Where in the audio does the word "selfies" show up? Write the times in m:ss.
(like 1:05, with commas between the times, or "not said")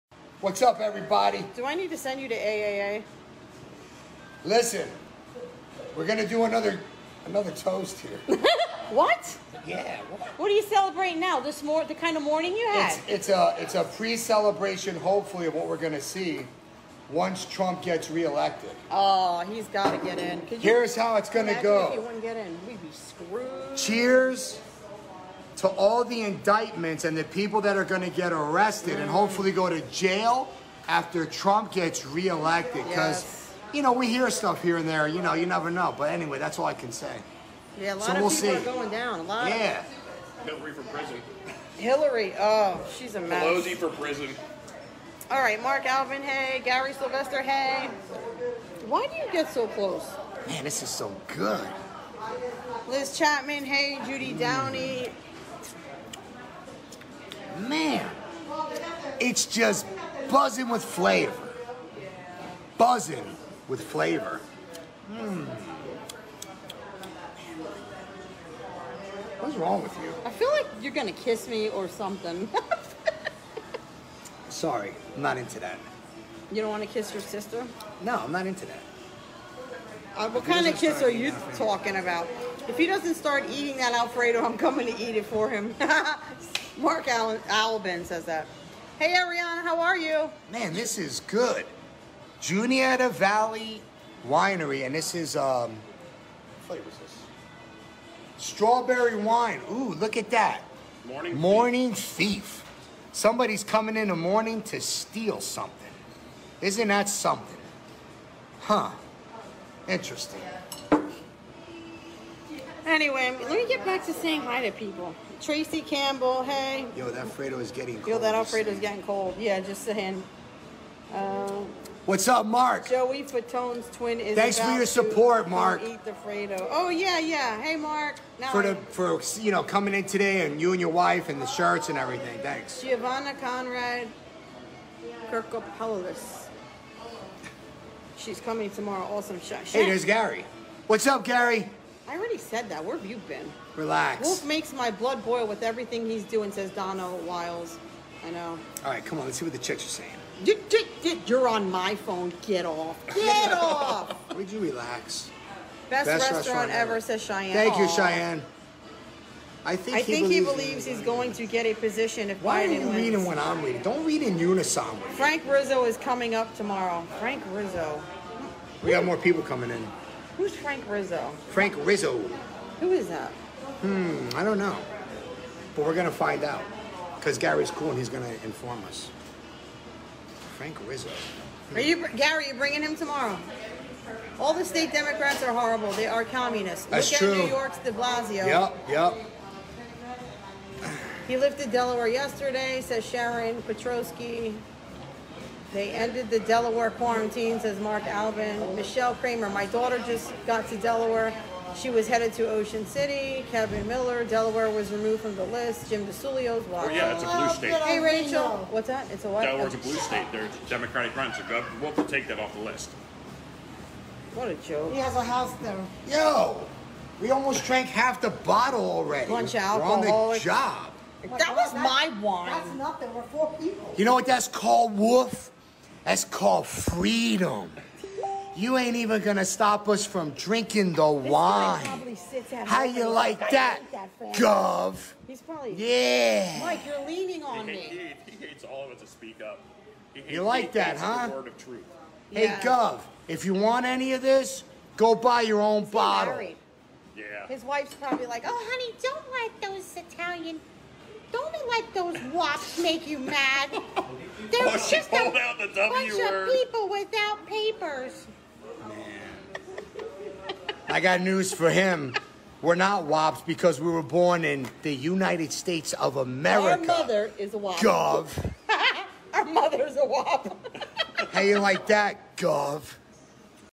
not said.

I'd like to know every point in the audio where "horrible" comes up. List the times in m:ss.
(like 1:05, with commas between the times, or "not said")
3:05.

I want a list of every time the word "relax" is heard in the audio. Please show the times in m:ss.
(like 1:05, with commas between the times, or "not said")
2:23, 2:34.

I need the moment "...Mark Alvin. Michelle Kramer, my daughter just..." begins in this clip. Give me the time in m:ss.
3:17.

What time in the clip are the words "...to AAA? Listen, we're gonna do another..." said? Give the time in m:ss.
0:02.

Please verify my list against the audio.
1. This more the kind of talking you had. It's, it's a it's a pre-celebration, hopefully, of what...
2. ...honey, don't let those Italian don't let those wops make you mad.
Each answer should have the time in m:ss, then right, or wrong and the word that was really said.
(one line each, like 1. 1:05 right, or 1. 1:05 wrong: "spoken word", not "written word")
1. 0:11 wrong: "morning", not "talking"
2. 4:08 right.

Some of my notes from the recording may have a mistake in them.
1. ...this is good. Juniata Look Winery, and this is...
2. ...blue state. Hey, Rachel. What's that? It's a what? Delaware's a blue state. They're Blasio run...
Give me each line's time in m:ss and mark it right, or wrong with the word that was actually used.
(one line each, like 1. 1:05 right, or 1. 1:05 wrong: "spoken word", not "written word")
1. 1:30 wrong: "Valley", not "Look"
2. 3:27 wrong: "Democratic", not "Blasio".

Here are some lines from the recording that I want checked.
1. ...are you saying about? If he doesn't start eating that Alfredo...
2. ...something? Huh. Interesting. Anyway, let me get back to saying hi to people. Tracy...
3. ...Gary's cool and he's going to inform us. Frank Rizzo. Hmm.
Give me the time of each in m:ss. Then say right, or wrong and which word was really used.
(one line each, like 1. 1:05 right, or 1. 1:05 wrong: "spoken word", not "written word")
1. 1:21 wrong: "talking", not "saying"
2. 1:47 right
3. 2:57 right.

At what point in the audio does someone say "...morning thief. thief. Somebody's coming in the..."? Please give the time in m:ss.
1:41.